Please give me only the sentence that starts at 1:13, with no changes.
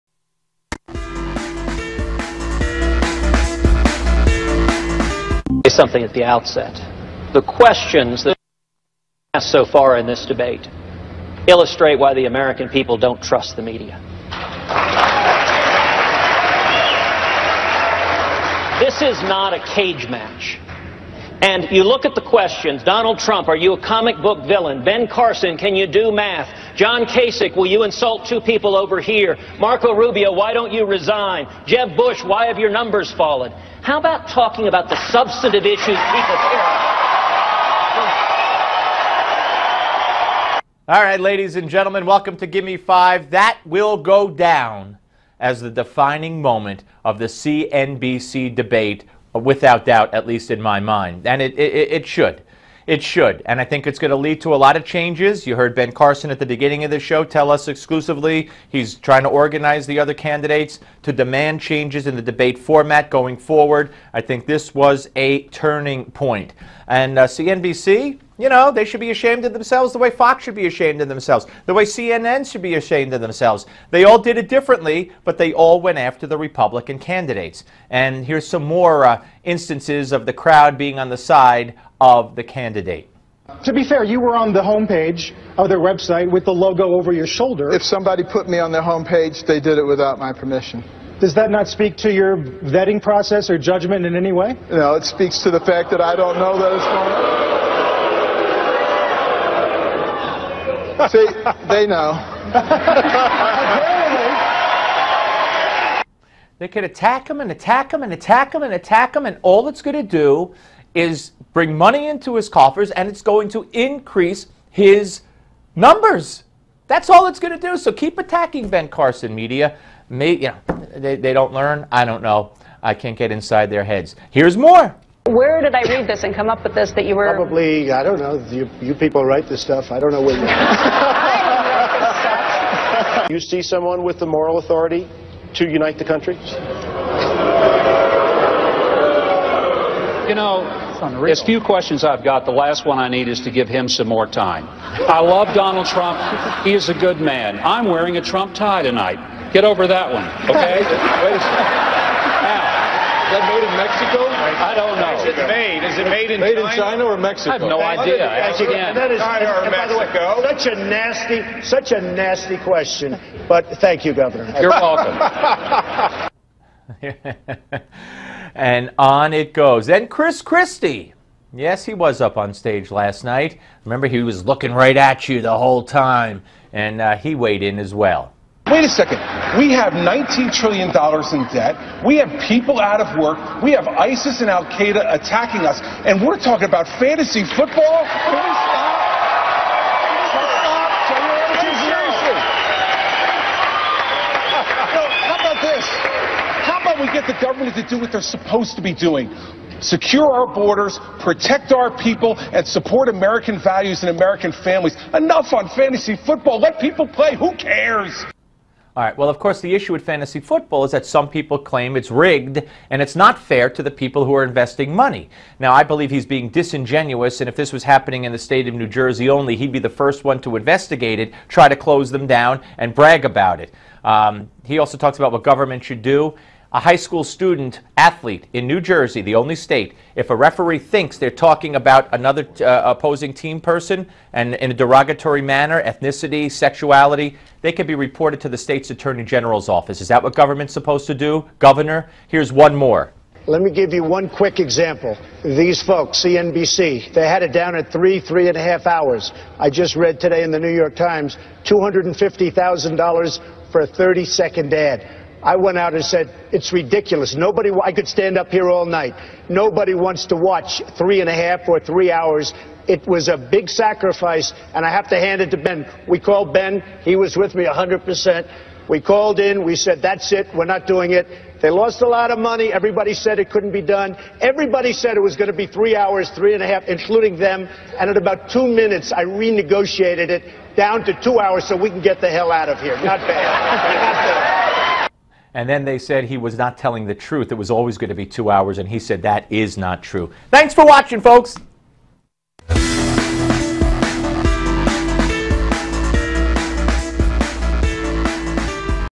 They all did it differently, but they all went after the Republican candidates.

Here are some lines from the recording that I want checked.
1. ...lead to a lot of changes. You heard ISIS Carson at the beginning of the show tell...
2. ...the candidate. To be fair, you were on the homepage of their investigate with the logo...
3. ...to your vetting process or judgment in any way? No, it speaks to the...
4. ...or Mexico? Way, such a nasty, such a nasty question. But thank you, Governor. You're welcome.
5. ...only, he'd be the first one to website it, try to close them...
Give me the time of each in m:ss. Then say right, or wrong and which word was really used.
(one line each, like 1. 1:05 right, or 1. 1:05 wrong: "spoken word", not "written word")
1. 0:54 wrong: "Ben", not "ISIS"
2. 1:22 wrong: "website", not "investigate"
3. 1:31 right
4. 2:39 right
5. 3:39 wrong: "investigate", not "website".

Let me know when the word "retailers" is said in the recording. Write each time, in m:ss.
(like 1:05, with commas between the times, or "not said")
not said.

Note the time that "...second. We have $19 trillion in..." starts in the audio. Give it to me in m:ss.
2:58.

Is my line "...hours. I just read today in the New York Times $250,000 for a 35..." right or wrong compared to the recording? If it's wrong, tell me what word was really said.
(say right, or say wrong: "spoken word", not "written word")
wrong: "30", not "35".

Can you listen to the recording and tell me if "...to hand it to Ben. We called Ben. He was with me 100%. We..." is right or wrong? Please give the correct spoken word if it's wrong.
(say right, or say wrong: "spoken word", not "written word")
right.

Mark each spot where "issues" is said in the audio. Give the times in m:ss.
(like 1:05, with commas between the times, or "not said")
0:35, 3:29.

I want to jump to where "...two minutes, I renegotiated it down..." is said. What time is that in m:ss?
4:38.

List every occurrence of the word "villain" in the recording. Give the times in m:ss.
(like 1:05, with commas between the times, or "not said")
0:24.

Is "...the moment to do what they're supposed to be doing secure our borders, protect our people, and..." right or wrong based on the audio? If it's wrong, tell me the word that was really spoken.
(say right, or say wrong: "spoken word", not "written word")
wrong: "government", not "moment".